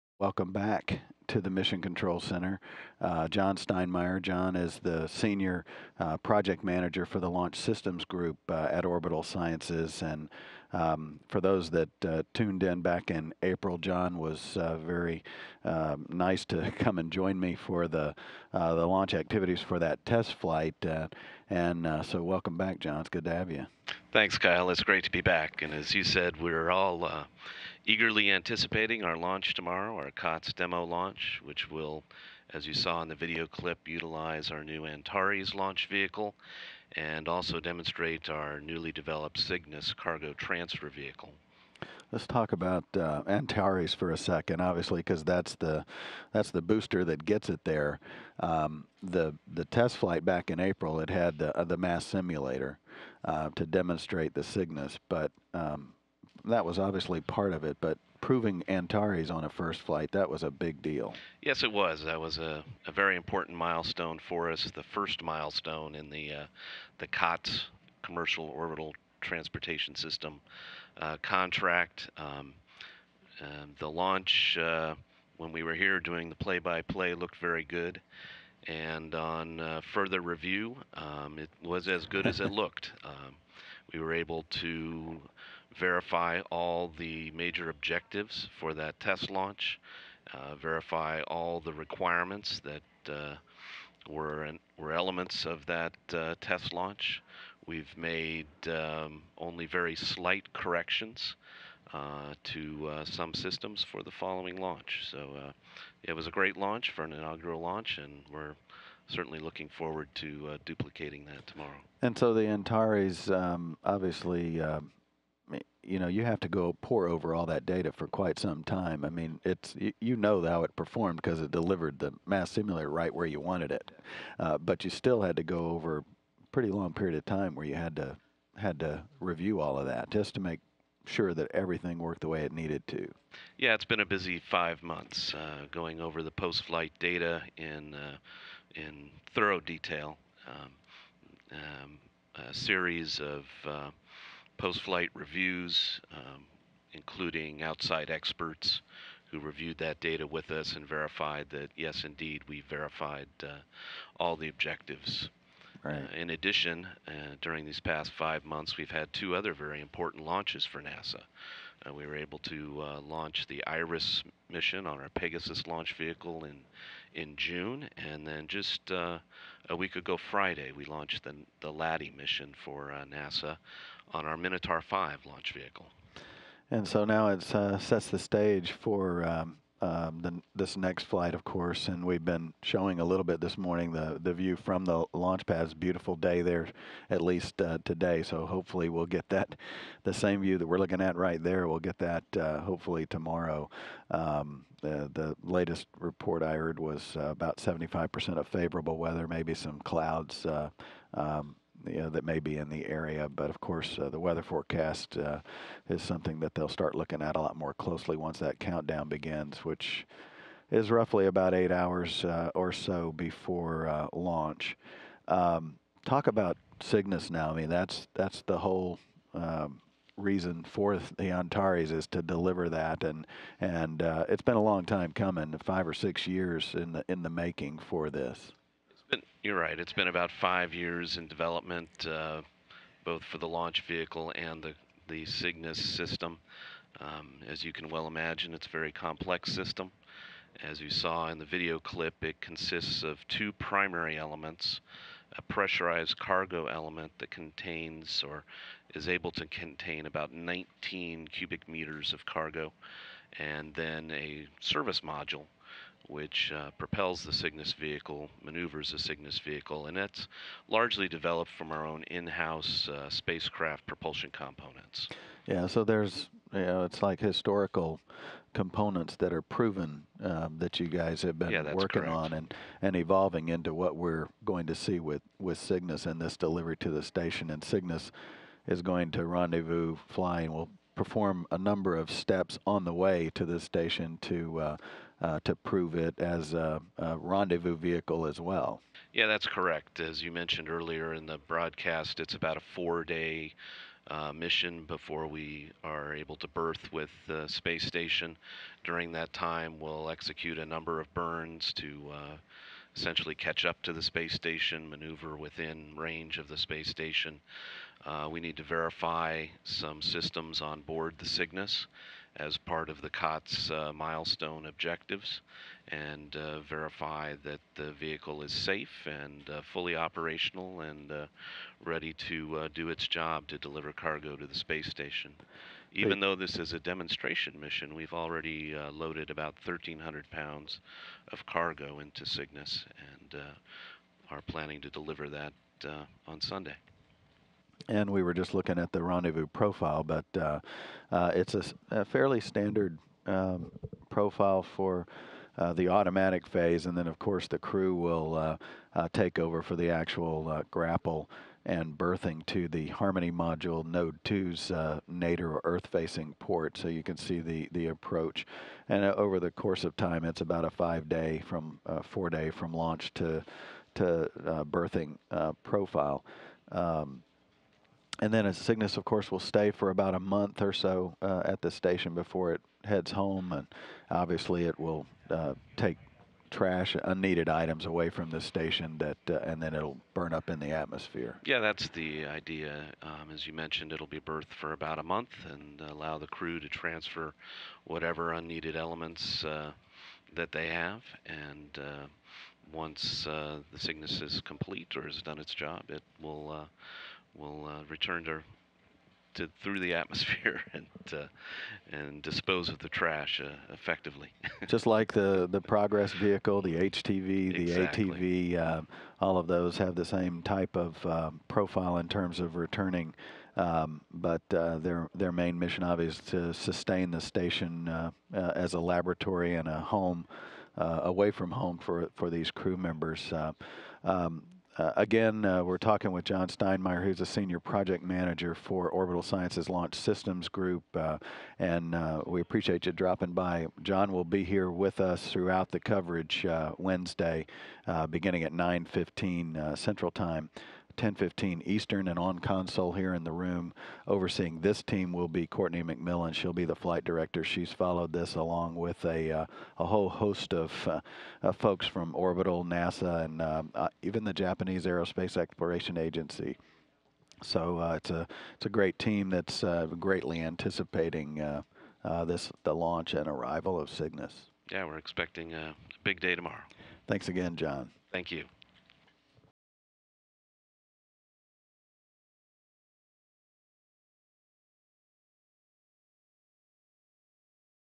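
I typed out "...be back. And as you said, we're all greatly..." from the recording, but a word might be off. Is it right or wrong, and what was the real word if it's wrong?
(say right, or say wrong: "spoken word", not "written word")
wrong: "eagerly", not "greatly".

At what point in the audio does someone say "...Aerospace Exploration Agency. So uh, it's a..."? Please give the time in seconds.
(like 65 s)
454 s.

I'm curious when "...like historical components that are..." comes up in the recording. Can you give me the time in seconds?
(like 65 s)
267 s.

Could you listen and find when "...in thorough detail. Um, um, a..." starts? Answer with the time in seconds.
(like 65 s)
138 s.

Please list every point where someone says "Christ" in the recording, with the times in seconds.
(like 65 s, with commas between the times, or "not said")
not said.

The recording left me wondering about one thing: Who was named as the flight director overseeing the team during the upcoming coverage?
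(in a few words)
Courtney McMillan.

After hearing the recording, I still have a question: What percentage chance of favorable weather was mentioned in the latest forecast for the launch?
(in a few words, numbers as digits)
75%.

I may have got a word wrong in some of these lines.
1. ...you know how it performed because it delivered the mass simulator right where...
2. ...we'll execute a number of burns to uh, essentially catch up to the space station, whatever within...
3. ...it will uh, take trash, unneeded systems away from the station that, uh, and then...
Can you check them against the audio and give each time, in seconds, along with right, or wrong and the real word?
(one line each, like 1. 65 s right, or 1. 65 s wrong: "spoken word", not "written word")
1. 119 s right
2. 299 s wrong: "maneuver", not "whatever"
3. 374 s wrong: "items", not "systems".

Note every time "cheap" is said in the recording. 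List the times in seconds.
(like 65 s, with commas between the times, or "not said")
not said.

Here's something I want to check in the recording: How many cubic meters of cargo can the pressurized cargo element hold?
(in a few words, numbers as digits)
19 cubic meters.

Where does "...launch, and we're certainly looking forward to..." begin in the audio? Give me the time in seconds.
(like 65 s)
107 s.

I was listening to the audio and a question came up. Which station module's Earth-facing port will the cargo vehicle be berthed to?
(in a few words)
Harmony module node 2.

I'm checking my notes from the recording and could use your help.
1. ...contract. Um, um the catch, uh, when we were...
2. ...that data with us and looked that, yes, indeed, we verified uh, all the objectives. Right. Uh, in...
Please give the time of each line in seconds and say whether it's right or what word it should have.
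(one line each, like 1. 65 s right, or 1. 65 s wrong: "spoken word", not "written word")
1. 71 s wrong: "launch", not "catch"
2. 149 s wrong: "verified", not "looked".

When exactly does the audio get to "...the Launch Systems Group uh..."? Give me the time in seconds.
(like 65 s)
7 s.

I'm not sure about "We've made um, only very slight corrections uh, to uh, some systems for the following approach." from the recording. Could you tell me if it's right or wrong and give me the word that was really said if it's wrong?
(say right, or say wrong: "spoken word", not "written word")
wrong: "launch", not "approach".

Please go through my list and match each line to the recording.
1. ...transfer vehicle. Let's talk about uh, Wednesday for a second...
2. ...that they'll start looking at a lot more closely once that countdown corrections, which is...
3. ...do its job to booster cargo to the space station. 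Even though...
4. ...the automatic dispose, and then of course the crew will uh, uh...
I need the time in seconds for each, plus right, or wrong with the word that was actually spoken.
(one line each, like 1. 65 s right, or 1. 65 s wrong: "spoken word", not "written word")
1. 40 s wrong: "Antares", not "Wednesday"
2. 206 s wrong: "begins", not "corrections"
3. 322 s wrong: "deliver", not "booster"
4. 345 s wrong: "phase", not "dispose".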